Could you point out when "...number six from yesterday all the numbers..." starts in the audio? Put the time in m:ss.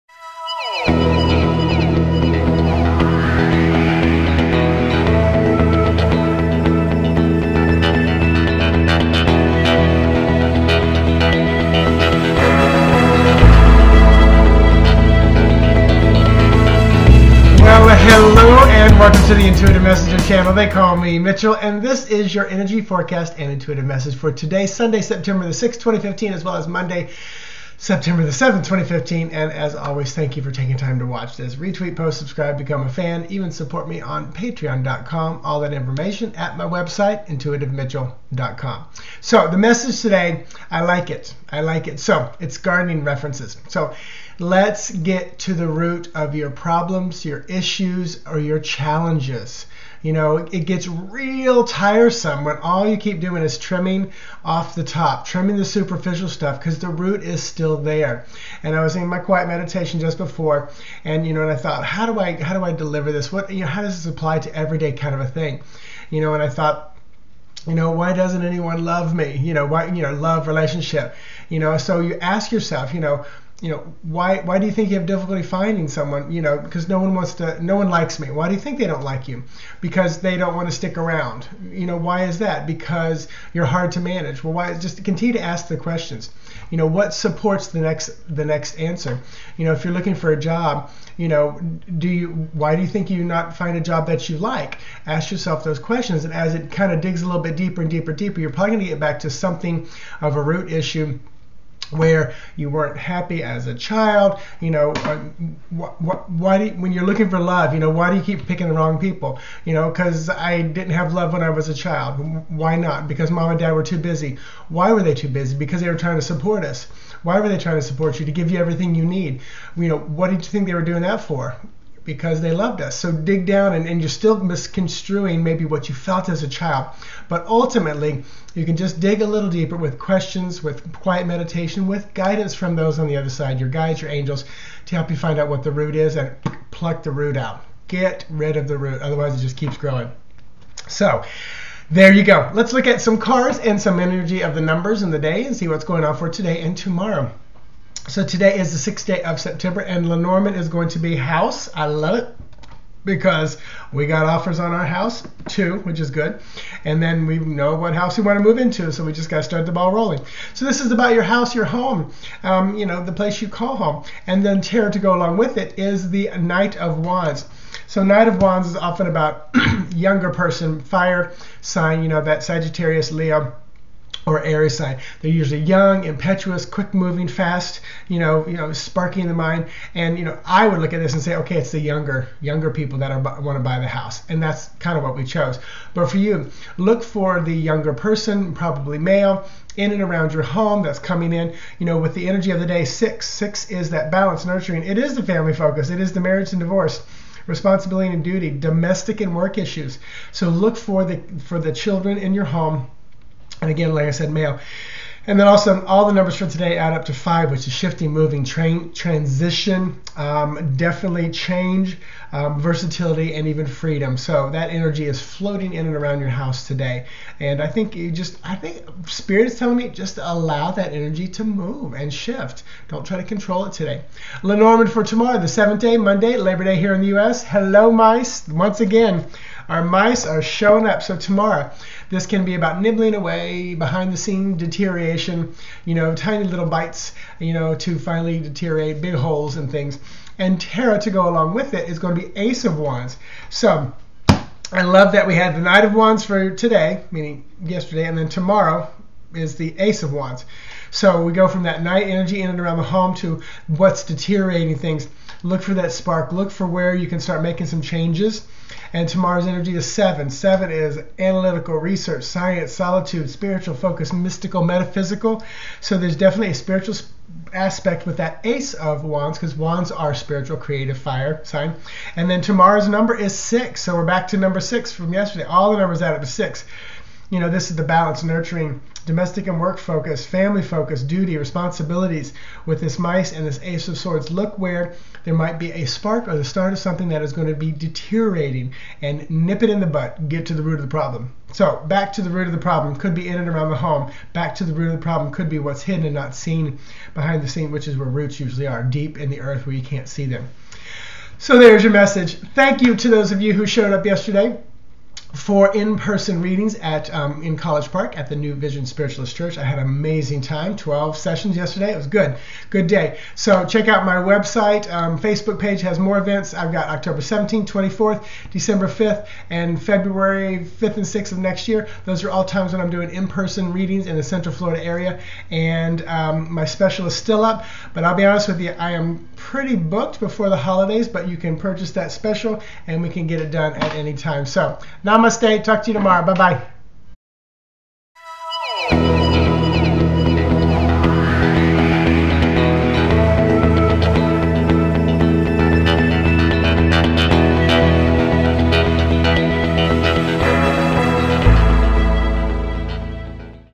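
4:34.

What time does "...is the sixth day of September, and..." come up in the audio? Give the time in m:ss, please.
2:28.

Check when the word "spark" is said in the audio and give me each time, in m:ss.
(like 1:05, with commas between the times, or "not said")
4:15, 4:45.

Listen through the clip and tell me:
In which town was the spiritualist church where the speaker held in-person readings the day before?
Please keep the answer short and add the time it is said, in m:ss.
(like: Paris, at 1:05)
College Park, at 5:07.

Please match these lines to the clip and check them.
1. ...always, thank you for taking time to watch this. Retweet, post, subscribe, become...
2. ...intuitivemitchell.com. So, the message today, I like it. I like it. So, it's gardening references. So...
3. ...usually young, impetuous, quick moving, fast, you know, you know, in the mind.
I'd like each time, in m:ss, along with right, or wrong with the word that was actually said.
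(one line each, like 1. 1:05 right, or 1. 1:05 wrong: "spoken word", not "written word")
1. 0:29 right
2. 0:37 right
3. 2:55 right.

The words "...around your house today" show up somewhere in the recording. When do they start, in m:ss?
3:35.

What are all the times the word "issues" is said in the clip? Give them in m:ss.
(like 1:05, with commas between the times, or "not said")
0:47, 1:40, 3:19.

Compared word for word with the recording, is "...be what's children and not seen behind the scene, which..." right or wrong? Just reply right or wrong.
wrong.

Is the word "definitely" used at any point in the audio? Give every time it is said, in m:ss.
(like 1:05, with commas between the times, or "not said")
3:30, 4:26.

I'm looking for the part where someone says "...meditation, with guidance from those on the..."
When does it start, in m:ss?
2:11.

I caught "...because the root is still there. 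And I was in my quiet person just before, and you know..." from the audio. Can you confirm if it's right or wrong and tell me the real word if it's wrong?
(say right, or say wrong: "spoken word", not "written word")
wrong: "meditation", not "person".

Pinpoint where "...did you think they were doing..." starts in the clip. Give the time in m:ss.
2:00.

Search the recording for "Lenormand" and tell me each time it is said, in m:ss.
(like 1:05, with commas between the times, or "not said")
2:30, 3:44.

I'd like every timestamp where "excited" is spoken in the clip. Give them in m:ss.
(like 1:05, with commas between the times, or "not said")
not said.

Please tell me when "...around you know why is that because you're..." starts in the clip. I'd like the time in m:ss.
1:20.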